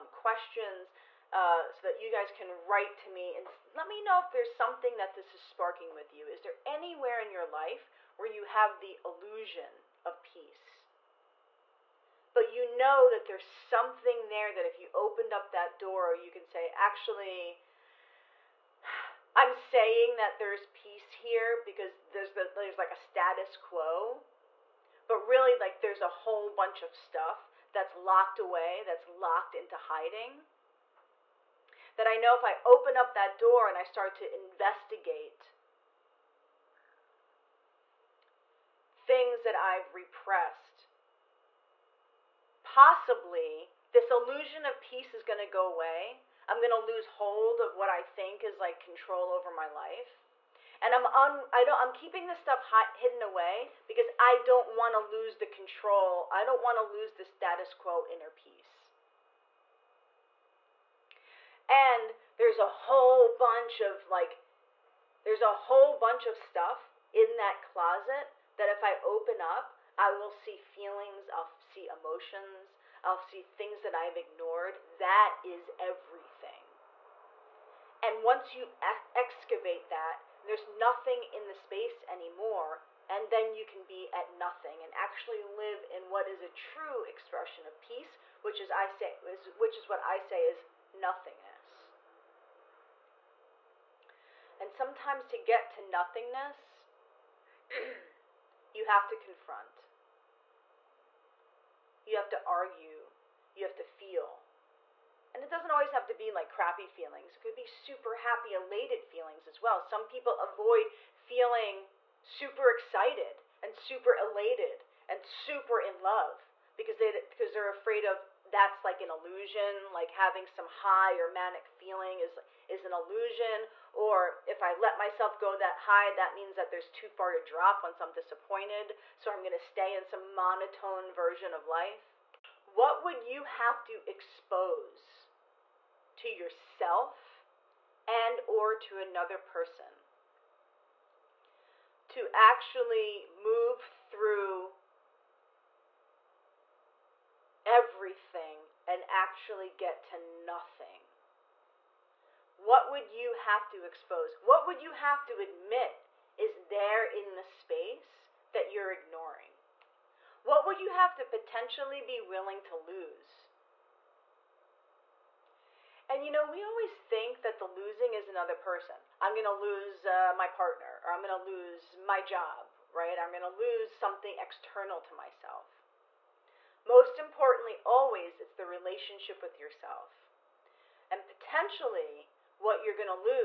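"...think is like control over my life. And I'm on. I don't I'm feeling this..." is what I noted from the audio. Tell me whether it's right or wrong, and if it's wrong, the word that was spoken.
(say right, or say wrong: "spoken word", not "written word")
wrong: "keeping", not "feeling".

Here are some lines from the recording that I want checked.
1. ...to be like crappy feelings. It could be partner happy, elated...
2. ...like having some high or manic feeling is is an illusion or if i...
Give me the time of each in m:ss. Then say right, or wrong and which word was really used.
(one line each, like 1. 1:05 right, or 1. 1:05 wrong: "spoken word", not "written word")
1. 1:46 wrong: "super", not "partner"
2. 1:59 right.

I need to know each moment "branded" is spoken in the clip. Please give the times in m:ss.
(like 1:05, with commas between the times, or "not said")
not said.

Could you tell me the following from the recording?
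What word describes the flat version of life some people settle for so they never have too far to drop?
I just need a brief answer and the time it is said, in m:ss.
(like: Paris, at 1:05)
Monotone, at 2:10.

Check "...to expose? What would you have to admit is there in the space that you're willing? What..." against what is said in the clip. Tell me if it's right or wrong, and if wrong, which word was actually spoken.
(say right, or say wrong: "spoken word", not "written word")
wrong: "ignoring", not "willing".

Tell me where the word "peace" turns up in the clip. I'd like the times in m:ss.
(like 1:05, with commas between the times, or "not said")
0:10, 0:20, 0:44, 0:58, 1:27.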